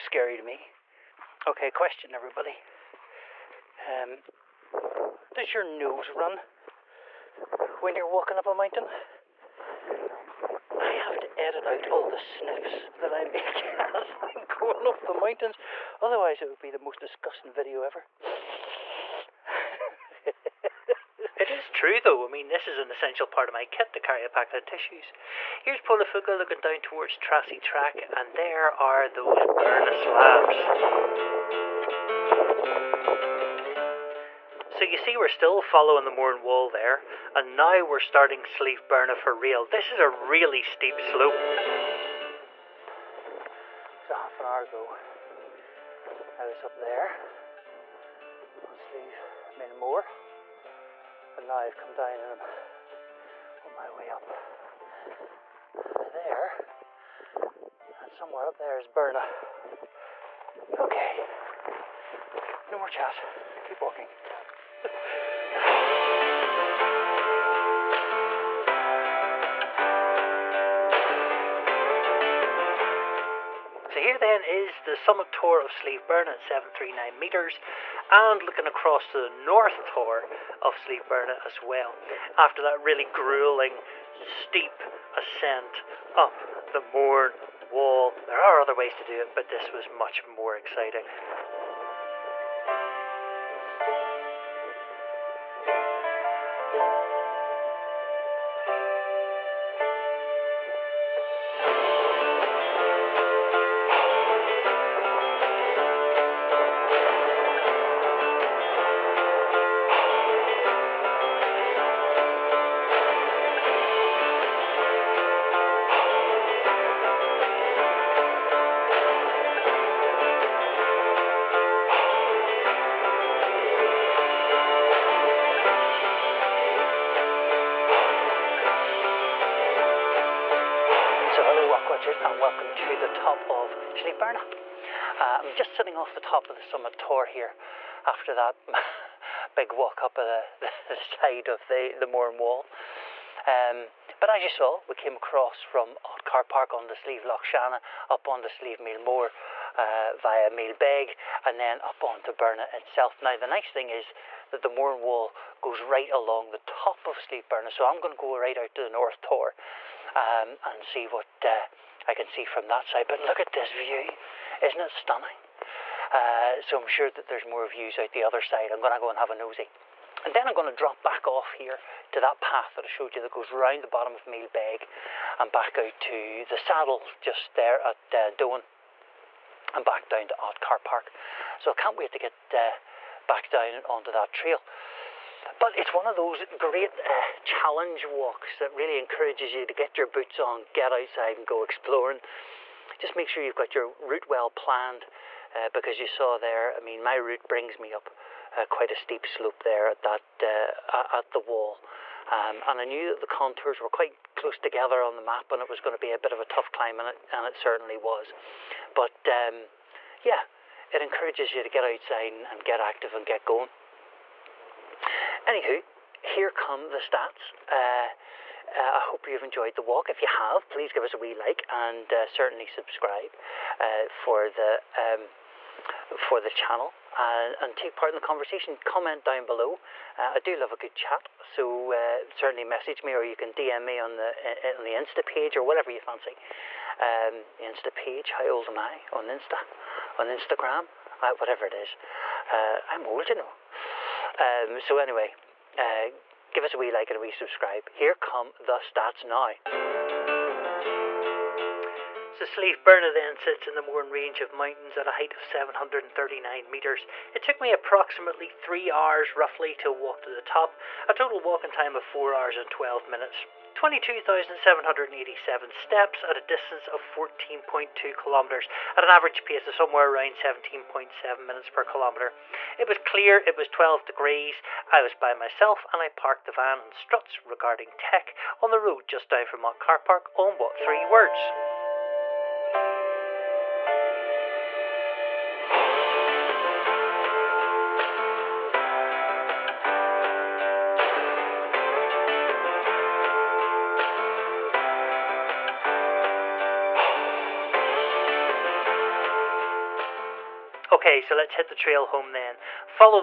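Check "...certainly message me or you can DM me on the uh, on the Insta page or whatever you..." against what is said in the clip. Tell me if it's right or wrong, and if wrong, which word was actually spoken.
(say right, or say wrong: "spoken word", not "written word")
right.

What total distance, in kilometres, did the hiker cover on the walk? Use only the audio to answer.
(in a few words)
14.2 km.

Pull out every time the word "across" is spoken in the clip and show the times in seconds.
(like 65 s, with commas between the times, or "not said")
78 s, 145 s.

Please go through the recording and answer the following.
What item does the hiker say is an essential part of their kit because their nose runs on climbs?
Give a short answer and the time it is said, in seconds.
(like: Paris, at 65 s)
a pack of tissues, at 24 s.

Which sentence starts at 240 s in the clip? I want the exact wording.
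On Instagram, uh, whatever it is.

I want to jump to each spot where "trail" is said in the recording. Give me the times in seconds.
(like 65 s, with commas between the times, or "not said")
184 s, 301 s.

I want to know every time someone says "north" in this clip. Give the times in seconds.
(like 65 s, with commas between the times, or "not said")
79 s, 158 s.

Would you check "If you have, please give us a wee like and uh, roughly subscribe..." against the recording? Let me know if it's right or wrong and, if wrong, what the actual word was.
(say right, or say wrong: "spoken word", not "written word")
wrong: "certainly", not "roughly".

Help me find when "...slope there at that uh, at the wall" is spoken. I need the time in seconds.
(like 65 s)
199 s.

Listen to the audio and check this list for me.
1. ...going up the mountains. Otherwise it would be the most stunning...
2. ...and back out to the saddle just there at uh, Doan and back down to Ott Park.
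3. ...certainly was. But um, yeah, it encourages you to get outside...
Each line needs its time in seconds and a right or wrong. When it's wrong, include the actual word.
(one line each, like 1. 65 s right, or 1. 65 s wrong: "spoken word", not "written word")
1. 14 s wrong: "disgusting", not "stunning"
2. 175 s right
3. 207 s right.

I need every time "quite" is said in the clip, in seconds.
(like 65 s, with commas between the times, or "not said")
198 s, 203 s.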